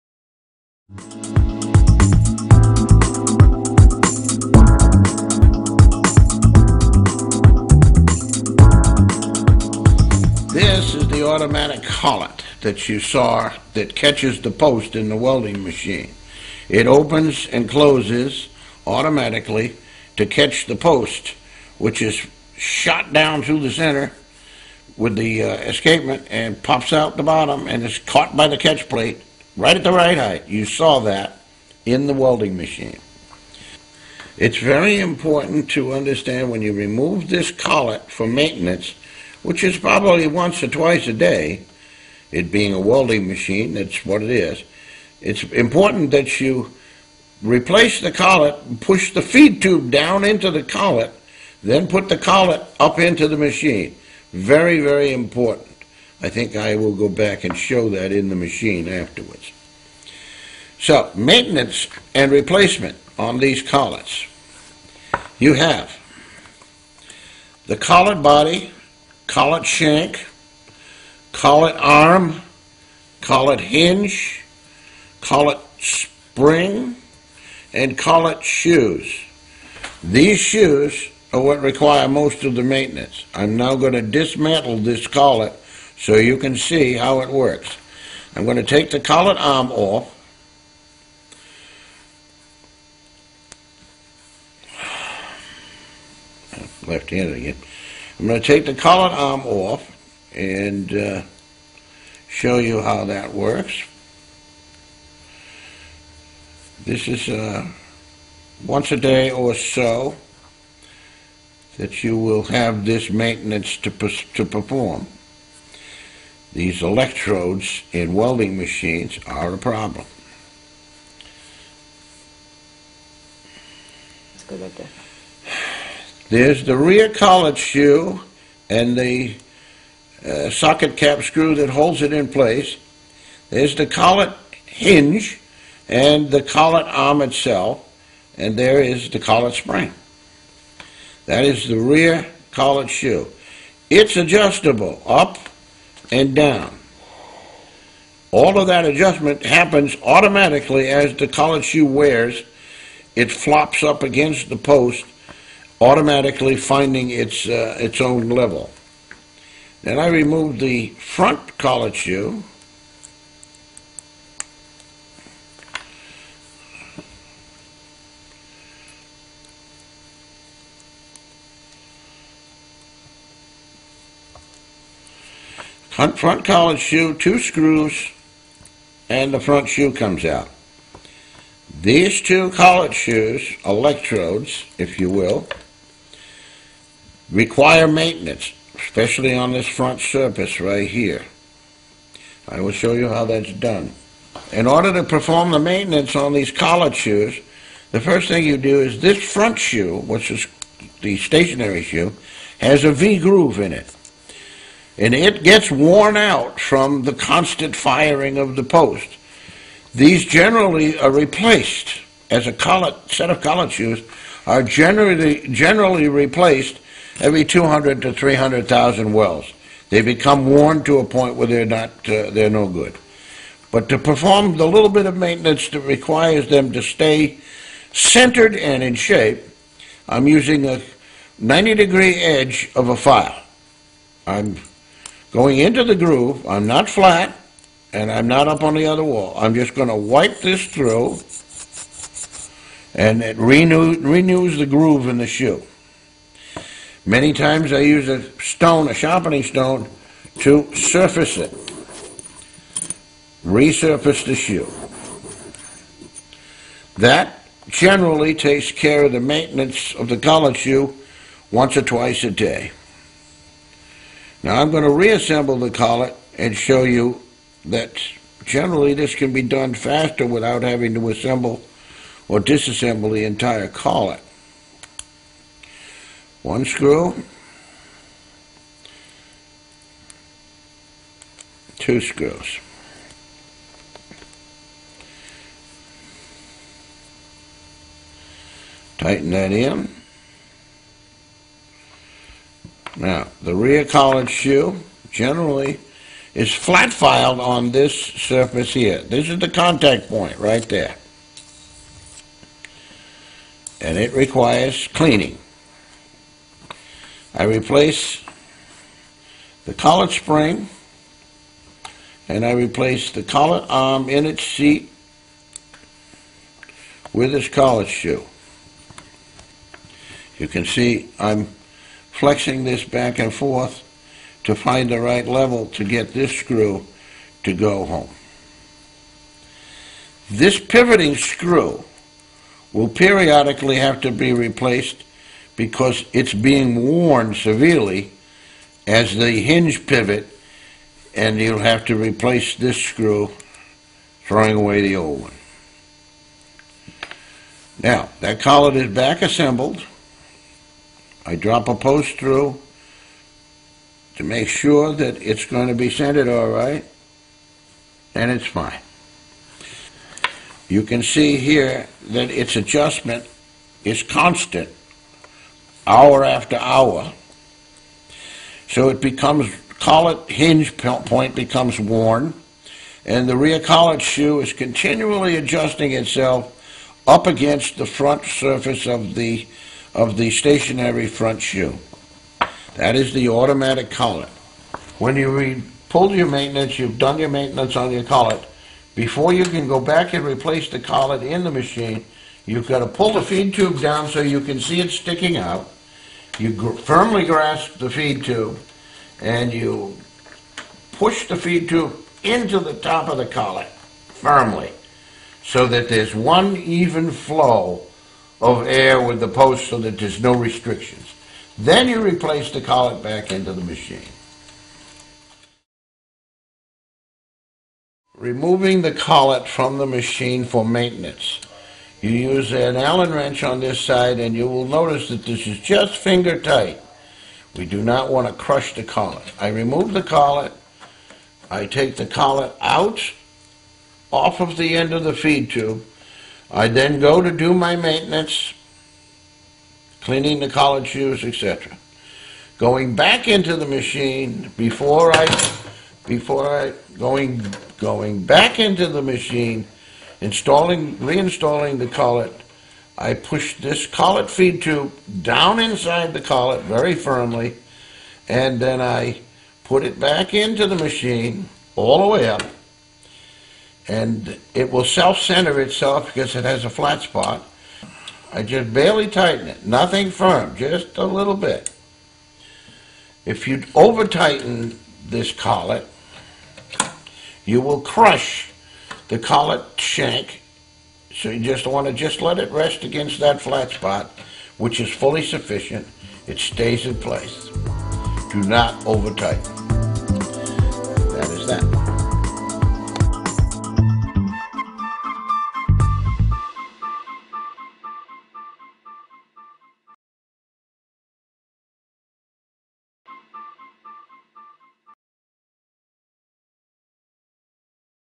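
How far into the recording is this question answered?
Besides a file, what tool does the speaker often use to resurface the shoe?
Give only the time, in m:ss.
4:08.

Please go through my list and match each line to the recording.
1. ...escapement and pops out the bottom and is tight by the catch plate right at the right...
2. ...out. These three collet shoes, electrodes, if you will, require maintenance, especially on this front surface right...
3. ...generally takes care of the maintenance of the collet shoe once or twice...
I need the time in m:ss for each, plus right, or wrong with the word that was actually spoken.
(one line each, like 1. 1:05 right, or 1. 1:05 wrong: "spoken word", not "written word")
1. 0:25 wrong: "caught", not "tight"
2. 3:00 wrong: "two", not "three"
3. 4:17 right.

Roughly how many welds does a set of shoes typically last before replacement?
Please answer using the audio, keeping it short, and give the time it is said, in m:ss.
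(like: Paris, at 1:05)
200,000 to 300,000, at 3:37.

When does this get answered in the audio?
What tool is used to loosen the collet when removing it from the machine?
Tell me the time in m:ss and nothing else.
7:02.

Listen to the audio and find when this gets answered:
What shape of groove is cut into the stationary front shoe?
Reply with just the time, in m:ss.
3:22.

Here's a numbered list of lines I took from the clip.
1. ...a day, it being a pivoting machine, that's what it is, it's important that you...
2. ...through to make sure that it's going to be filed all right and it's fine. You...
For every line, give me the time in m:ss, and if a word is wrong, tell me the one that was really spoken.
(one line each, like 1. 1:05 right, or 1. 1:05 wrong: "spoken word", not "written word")
1. 0:41 wrong: "welding", not "pivoting"
2. 5:52 wrong: "centered", not "filed".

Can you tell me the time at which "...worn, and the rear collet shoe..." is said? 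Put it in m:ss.
6:11.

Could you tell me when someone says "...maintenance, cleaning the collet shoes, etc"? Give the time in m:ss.
7:17.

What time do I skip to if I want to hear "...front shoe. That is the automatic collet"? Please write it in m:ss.
6:21.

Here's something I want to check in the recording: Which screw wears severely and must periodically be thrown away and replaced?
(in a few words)
pivoting screw.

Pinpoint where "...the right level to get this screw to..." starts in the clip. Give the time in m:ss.
5:24.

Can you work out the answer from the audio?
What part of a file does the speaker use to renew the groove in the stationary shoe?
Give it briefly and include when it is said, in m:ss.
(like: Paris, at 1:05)
90 degree edge, at 3:51.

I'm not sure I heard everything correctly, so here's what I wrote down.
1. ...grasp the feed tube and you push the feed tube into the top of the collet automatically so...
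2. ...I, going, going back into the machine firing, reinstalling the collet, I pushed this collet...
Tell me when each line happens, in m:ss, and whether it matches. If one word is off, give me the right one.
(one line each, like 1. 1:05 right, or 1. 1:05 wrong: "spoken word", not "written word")
1. 6:37 wrong: "firmly", not "automatically"
2. 7:26 wrong: "installing", not "firing".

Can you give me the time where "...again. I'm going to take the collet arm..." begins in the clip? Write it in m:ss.
1:37.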